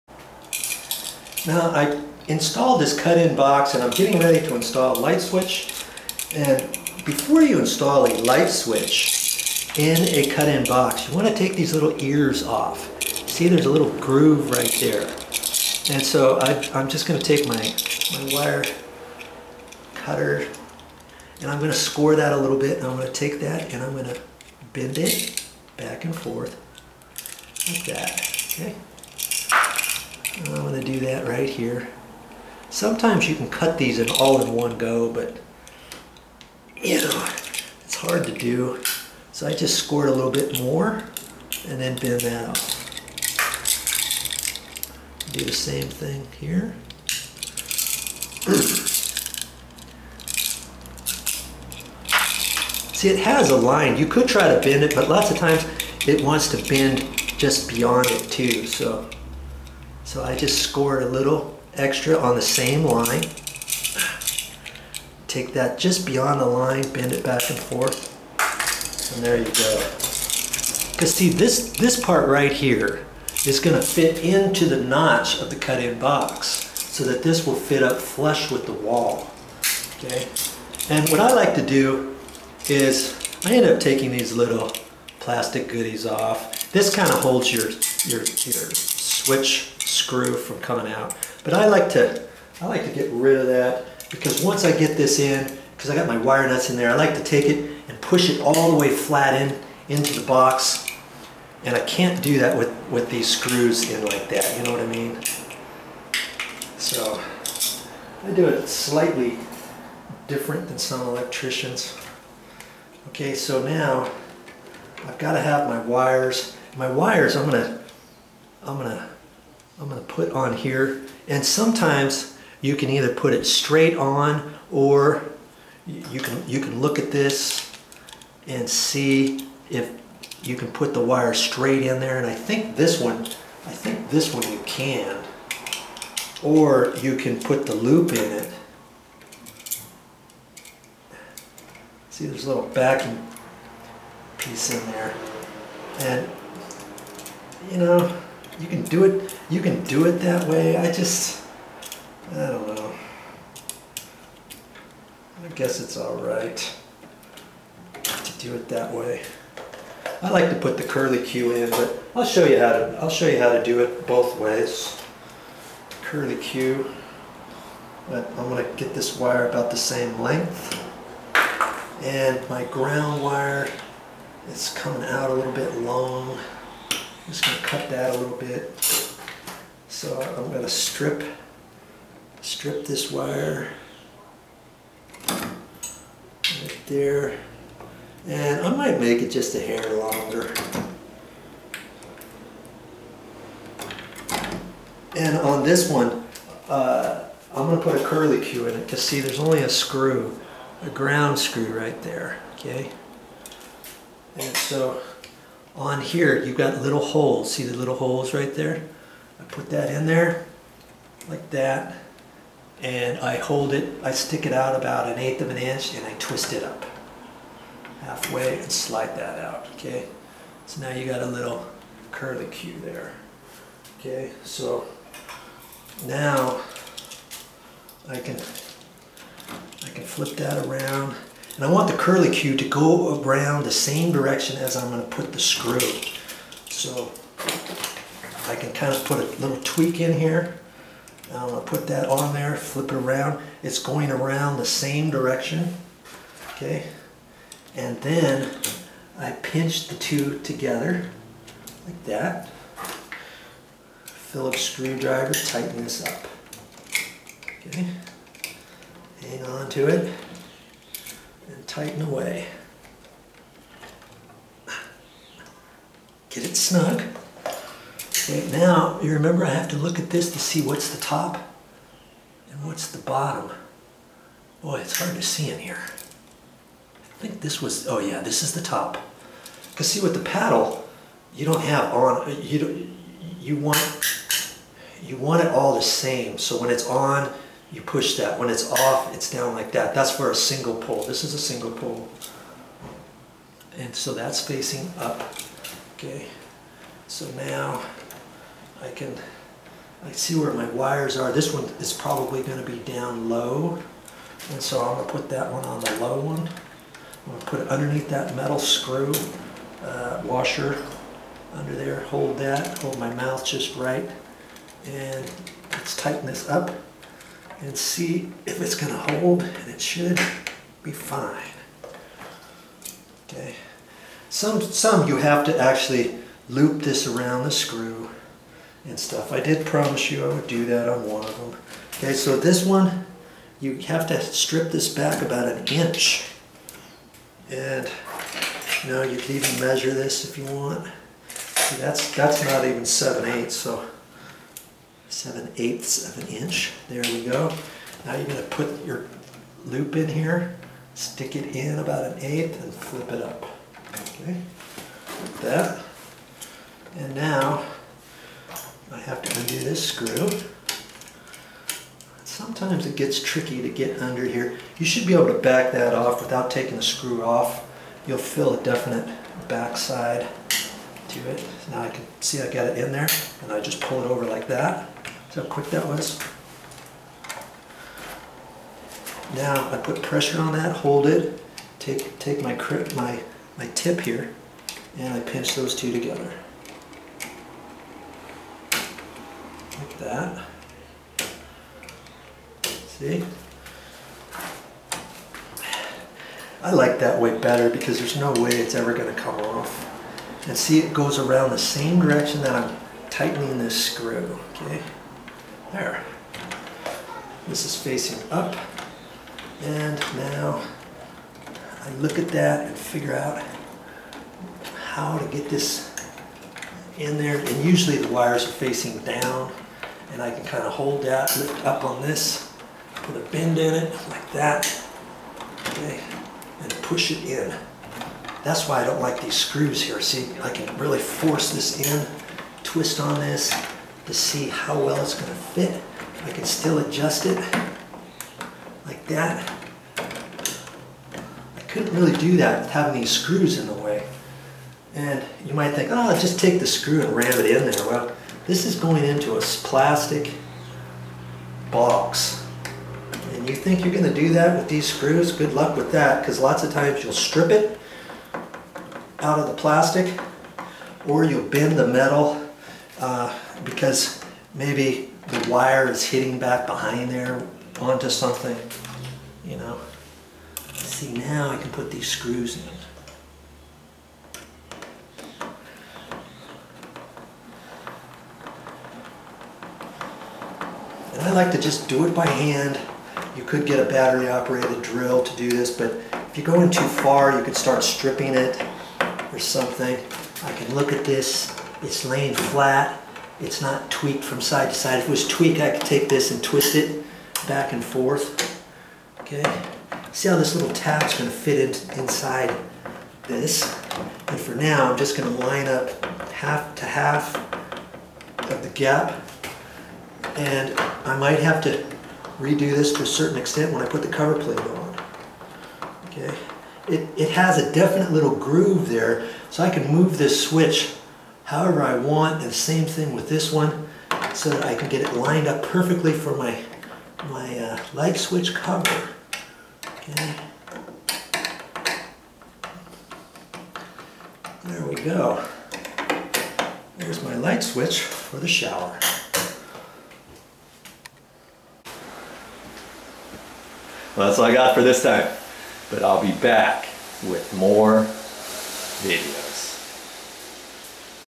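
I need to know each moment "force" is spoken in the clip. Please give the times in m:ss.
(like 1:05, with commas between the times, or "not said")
7:10.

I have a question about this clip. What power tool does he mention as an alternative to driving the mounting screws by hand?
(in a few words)
Battery operated drill.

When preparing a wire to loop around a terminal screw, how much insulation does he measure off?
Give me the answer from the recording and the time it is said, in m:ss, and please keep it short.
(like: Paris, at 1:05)
7/8 inch, at 5:45.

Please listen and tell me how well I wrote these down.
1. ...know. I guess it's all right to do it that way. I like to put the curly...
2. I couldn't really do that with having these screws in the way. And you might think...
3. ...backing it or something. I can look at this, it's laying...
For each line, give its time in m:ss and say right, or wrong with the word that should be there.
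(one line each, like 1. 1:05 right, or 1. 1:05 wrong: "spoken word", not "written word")
1. 2:32 right
2. 7:19 right
3. 8:07 wrong: "stripping", not "backing".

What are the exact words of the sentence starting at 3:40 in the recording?
So now you got a little curly cue there, okay?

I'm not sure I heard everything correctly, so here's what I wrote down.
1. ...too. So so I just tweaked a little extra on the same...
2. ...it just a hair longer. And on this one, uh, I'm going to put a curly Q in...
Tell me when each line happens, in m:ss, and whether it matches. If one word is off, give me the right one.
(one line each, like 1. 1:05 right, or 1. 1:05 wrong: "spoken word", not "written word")
1. 0:58 wrong: "scored", not "tweaked"
2. 3:09 right.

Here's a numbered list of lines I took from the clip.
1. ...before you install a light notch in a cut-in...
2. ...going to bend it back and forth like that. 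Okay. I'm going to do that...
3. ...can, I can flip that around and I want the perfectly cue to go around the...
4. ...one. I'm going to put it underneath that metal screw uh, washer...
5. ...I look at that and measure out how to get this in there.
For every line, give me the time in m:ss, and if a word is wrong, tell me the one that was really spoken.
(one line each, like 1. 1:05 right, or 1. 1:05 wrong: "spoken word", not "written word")
1. 0:07 wrong: "switch", not "notch"
2. 0:23 right
3. 3:48 wrong: "curly", not "perfectly"
4. 5:06 right
5. 6:51 wrong: "figure", not "measure".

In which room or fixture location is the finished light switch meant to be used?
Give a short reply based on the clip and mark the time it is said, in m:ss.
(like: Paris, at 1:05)
Shower, at 8:58.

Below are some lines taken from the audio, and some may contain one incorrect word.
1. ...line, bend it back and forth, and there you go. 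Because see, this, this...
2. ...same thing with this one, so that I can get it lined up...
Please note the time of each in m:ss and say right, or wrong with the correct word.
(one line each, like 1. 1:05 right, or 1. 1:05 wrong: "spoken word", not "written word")
1. 1:06 right
2. 8:42 right.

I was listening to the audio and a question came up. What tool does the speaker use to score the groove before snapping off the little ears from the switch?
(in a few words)
Wire cutter.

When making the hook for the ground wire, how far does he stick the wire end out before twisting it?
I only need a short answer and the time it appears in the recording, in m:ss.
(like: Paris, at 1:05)
An eighth of an inch, at 3:35.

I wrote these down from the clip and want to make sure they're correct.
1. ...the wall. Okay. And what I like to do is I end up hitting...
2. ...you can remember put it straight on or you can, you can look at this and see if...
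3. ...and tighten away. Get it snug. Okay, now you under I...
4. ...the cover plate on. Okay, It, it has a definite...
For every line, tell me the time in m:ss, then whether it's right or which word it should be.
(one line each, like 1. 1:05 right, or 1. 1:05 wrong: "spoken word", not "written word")
1. 1:18 wrong: "taking", not "hitting"
2. 2:02 wrong: "either", not "remember"
3. 4:21 wrong: "remember", not "under"
4. 8:34 right.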